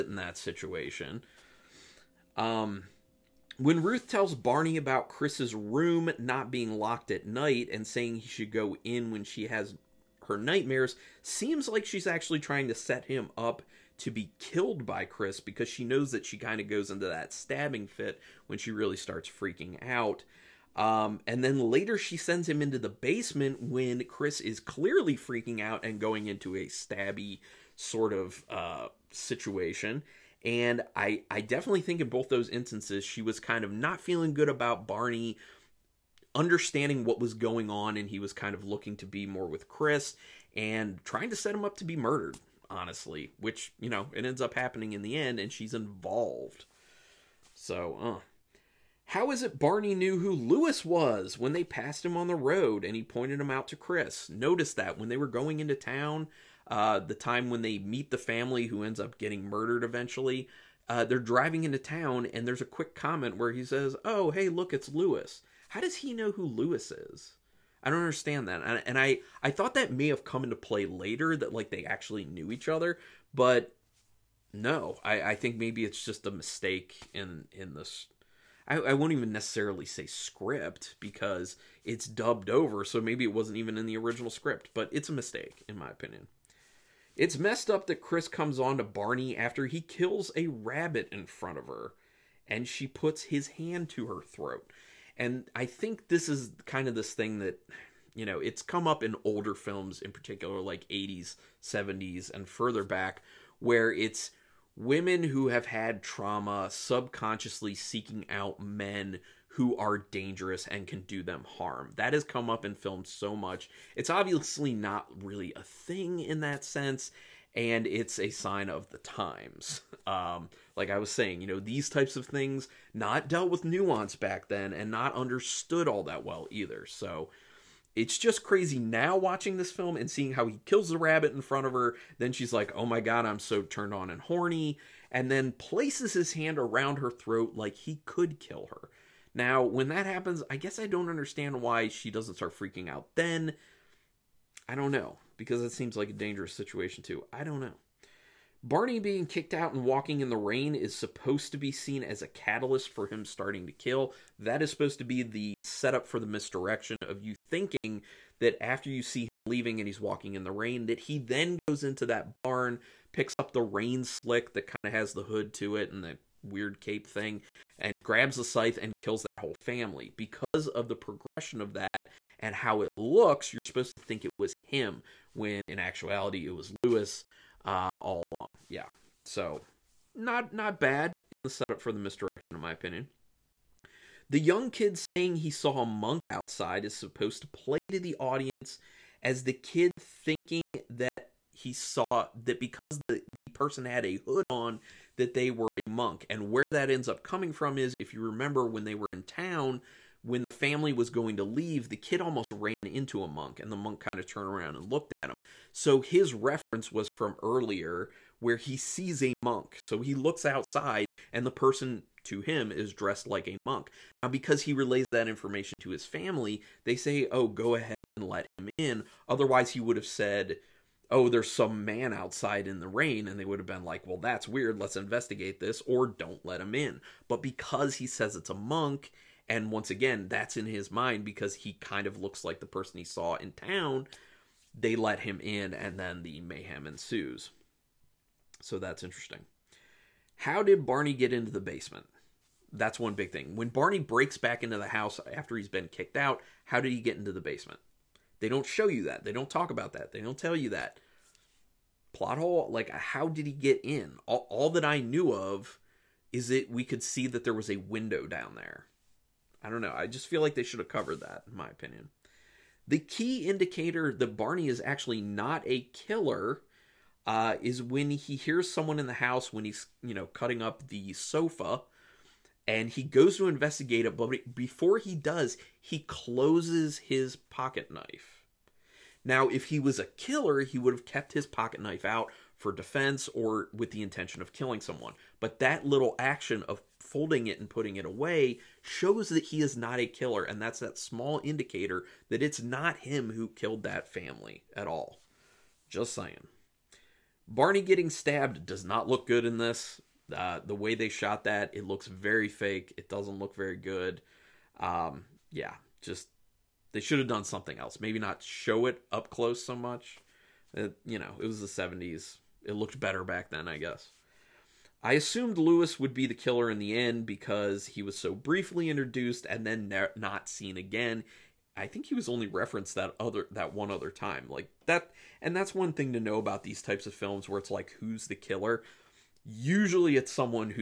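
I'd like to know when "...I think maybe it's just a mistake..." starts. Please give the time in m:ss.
1:15.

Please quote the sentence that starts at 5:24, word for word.
Like that and that's one thing to know about these types of films where it's like who's the killer?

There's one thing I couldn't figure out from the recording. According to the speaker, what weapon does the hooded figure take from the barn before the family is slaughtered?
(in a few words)
Scythe.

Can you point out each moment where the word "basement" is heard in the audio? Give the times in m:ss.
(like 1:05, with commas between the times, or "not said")
0:22, 4:01, 4:07.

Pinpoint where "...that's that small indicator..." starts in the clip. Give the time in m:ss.
4:50.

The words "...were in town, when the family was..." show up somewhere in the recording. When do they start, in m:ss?
3:18.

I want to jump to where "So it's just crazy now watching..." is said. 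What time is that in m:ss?
2:06.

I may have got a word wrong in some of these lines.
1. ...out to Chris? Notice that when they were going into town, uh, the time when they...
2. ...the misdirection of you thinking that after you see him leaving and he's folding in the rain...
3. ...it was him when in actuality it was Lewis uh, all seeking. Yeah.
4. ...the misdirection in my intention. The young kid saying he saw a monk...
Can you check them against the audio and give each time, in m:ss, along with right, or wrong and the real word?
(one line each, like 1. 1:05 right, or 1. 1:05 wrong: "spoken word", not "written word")
1. 0:53 right
2. 2:36 wrong: "walking", not "folding"
3. 2:54 wrong: "along", not "seeking"
4. 3:01 wrong: "opinion", not "intention".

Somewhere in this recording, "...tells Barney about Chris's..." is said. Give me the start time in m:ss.
0:04.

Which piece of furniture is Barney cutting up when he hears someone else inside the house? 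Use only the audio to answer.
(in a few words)
Sofa.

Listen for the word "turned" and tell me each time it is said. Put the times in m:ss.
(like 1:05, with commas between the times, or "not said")
2:13, 3:24.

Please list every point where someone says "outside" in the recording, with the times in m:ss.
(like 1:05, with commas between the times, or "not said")
3:06, 3:30, 3:42.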